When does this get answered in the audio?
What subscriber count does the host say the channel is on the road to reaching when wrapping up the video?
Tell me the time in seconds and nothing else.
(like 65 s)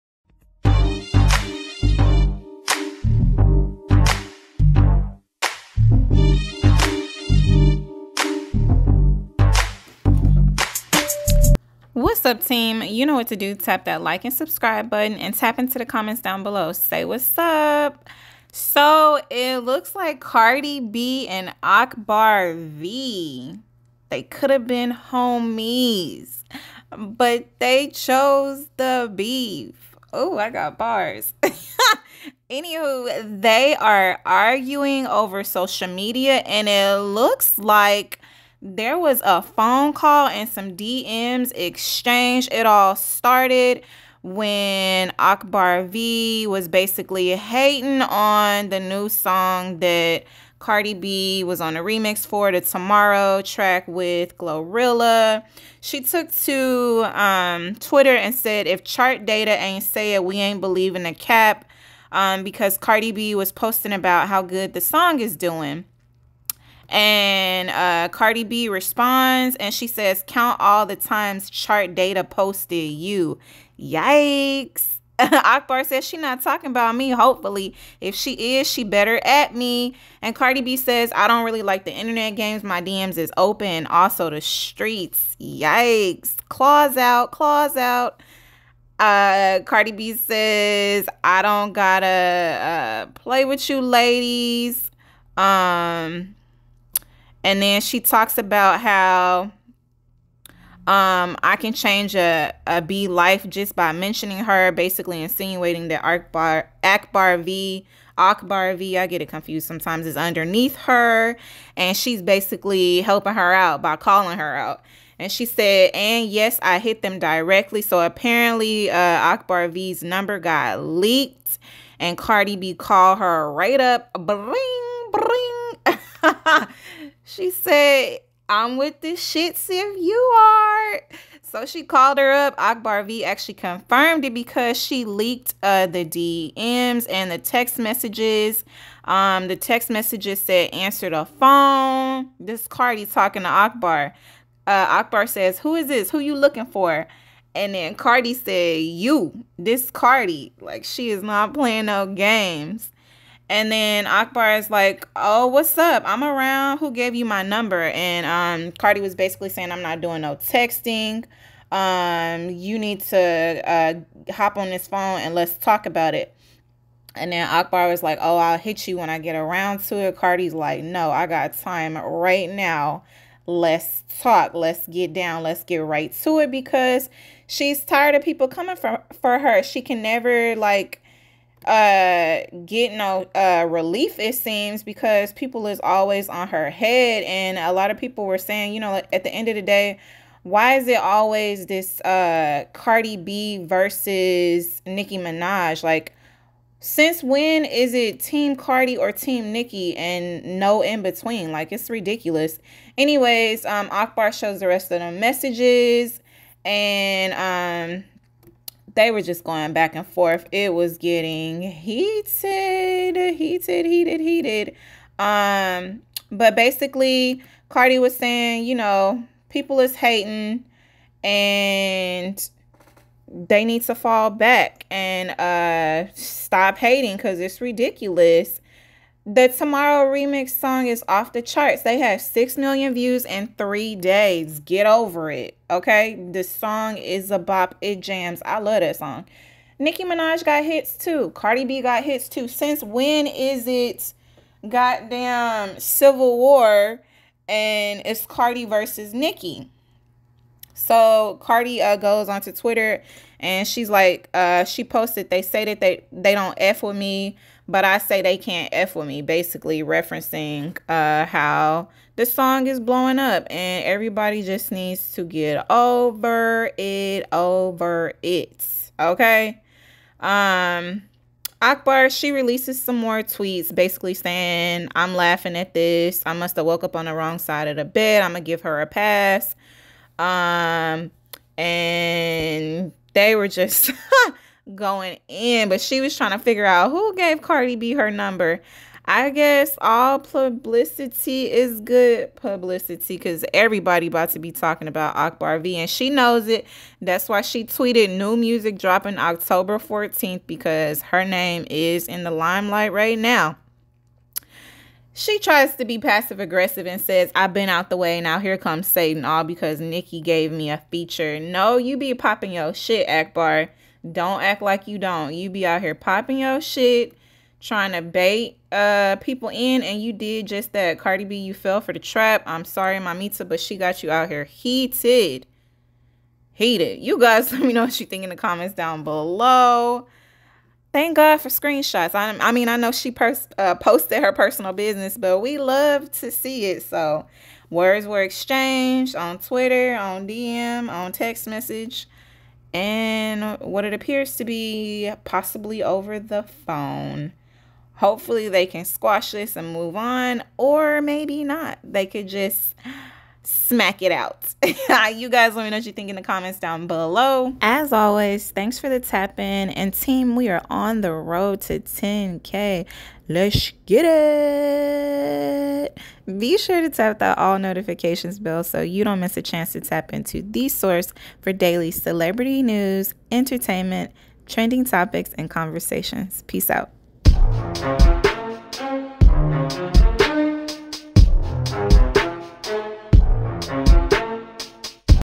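361 s.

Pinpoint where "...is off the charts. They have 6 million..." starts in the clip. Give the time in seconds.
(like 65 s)
230 s.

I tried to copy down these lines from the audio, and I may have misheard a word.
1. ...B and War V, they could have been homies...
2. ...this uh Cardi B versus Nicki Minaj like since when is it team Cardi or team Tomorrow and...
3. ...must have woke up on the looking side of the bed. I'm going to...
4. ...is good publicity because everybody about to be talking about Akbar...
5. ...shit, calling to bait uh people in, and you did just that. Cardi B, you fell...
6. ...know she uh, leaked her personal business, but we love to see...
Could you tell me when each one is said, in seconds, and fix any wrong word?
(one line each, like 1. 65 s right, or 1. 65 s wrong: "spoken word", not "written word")
1. 20 s wrong: "Akbar", not "War"
2. 191 s wrong: "Nicki", not "Tomorrow"
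3. 276 s wrong: "wrong", not "looking"
4. 291 s right
5. 316 s wrong: "trying", not "calling"
6. 332 s wrong: "posted", not "leaked".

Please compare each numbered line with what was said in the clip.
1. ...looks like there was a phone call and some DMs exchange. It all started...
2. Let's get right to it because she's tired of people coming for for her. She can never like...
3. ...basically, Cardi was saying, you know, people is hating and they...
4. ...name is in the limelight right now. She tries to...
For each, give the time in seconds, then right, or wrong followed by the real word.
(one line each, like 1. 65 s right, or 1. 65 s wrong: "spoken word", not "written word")
1. 37 s right
2. 175 s right
3. 216 s right
4. 301 s right.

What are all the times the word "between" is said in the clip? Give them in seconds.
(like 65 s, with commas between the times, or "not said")
201 s.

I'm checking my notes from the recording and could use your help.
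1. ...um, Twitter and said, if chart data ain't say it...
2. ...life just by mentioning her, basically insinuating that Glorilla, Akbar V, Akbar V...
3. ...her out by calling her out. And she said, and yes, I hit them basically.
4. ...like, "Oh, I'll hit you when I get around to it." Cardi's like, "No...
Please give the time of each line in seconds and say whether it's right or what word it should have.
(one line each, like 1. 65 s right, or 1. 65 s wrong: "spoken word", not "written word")
1. 57 s right
2. 103 s wrong: "Akbar", not "Glorilla"
3. 113 s wrong: "directly", not "basically"
4. 168 s right.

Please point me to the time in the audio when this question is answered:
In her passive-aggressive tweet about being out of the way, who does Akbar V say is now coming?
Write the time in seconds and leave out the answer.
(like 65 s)
308 s.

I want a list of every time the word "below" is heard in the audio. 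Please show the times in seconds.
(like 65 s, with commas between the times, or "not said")
16 s, 329 s, 356 s.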